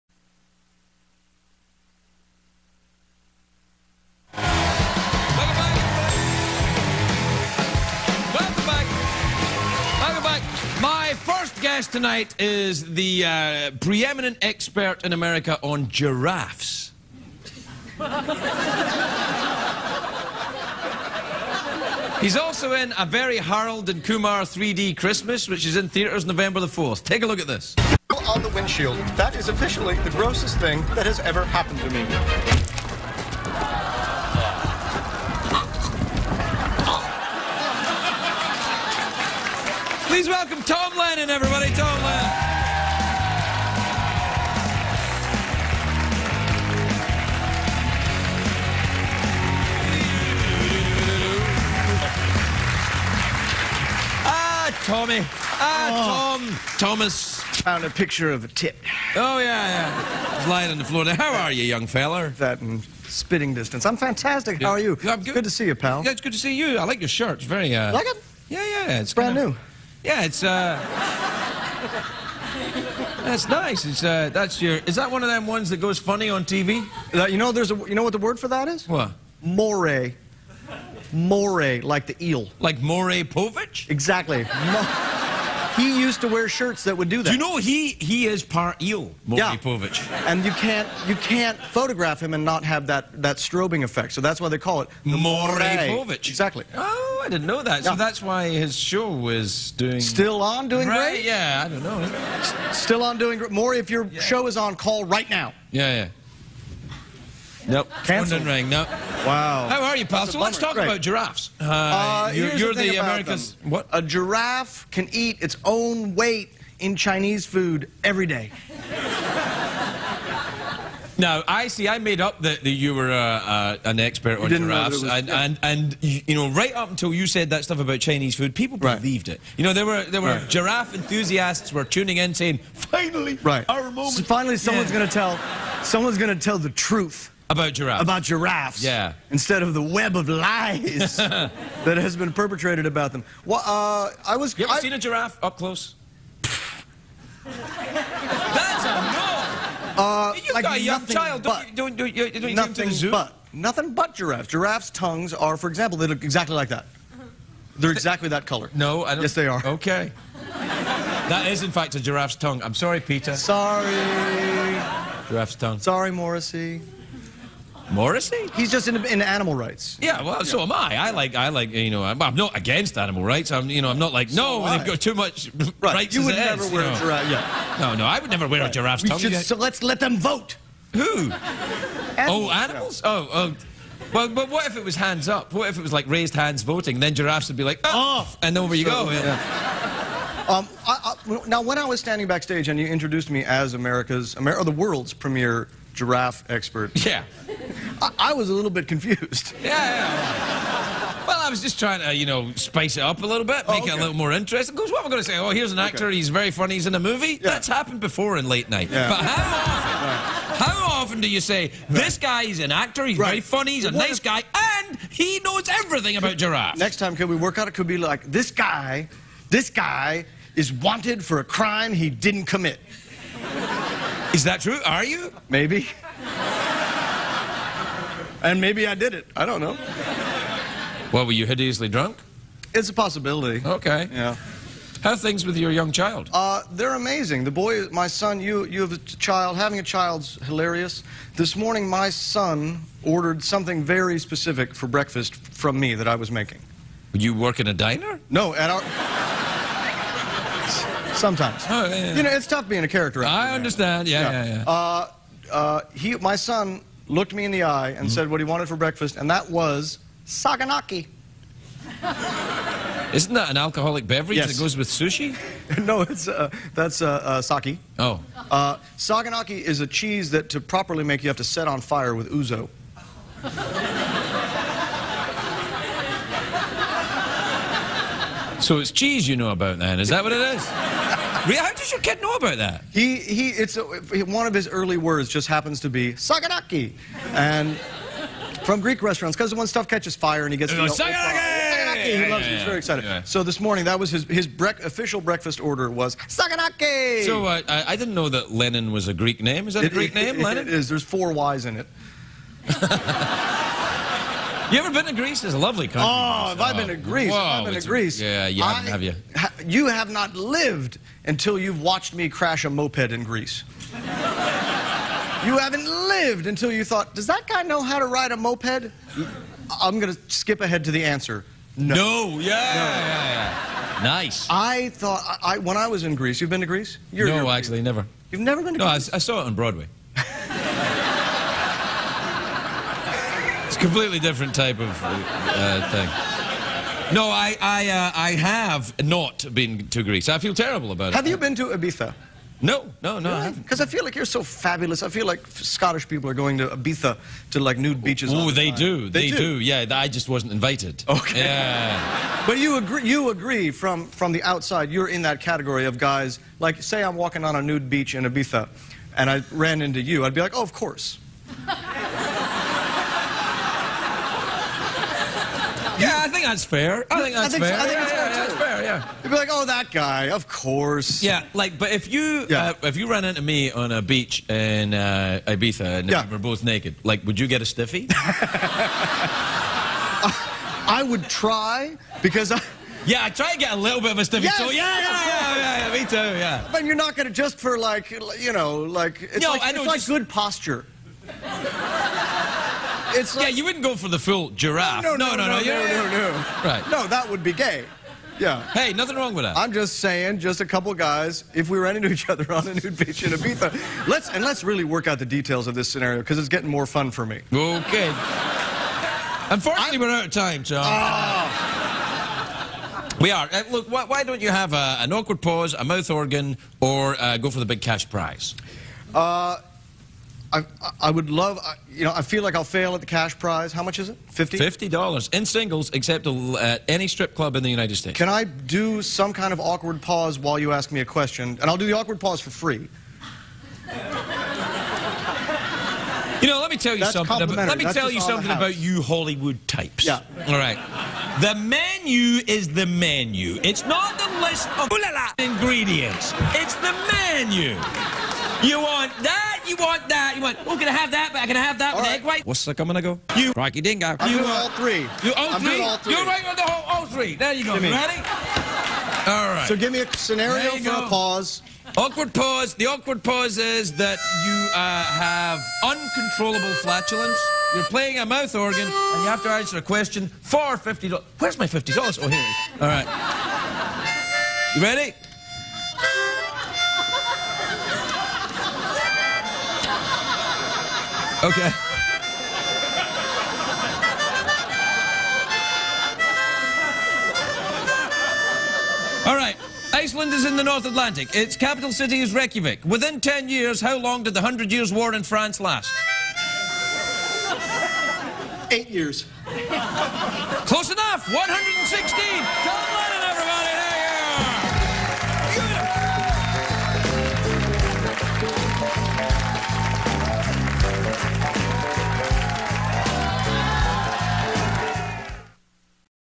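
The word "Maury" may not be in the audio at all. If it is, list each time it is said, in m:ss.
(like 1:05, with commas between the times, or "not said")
1:22, 1:43.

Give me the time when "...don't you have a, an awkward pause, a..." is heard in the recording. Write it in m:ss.
6:54.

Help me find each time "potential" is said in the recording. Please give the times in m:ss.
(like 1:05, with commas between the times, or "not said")
not said.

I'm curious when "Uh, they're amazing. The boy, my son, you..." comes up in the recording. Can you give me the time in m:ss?
3:56.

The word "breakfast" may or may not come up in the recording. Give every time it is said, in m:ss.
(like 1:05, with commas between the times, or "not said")
4:04, 4:18, 4:55.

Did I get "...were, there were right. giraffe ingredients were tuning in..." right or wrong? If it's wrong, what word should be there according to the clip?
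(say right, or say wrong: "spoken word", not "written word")
wrong: "enthusiasts", not "ingredients".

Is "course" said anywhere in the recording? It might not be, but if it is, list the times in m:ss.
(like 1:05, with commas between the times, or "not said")
6:00, 6:10.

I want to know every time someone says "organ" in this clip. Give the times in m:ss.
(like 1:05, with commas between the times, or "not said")
6:56, 7:48.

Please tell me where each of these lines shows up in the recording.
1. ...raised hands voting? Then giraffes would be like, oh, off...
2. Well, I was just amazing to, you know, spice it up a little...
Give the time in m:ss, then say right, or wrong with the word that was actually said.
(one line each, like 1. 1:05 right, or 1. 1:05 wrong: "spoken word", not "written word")
1. 3:06 right
2. 3:21 wrong: "trying", not "amazing".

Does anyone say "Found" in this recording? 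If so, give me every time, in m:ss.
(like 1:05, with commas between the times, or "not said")
0:57.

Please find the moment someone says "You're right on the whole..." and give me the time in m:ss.
7:36.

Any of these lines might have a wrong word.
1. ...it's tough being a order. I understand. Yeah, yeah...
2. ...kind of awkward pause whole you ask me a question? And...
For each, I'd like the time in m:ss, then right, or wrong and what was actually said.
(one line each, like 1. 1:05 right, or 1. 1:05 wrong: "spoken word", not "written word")
1. 4:12 wrong: "character", not "order"
2. 7:09 wrong: "while", not "whole".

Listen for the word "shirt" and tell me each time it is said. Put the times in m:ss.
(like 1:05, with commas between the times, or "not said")
1:07, 1:26.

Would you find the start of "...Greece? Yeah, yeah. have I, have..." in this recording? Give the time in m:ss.
5:07.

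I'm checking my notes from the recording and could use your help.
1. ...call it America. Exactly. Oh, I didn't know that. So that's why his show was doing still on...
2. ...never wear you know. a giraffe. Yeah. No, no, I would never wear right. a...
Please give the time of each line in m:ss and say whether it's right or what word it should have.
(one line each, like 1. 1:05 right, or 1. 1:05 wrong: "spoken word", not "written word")
1. 1:34 wrong: "Mornipovich", not "America"
2. 2:56 right.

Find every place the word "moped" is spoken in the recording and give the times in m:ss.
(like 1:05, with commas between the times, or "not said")
5:12, 5:18.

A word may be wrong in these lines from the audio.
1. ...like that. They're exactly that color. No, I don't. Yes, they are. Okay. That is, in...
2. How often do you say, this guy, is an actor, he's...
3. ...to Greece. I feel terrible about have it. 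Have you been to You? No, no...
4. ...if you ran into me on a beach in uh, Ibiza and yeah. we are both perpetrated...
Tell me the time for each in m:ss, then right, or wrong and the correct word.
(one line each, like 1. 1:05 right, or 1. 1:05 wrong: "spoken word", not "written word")
1. 2:36 right
2. 3:30 right
3. 5:39 wrong: "Ibiza", not "You"
4. 6:12 wrong: "naked", not "perpetrated".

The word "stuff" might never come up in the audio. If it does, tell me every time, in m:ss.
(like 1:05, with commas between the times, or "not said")
2:07, 4:49.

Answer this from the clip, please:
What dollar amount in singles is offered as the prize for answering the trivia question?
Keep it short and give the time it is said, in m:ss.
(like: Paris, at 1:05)
$50, at 7:04.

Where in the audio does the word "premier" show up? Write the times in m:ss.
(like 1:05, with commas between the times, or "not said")
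3:15.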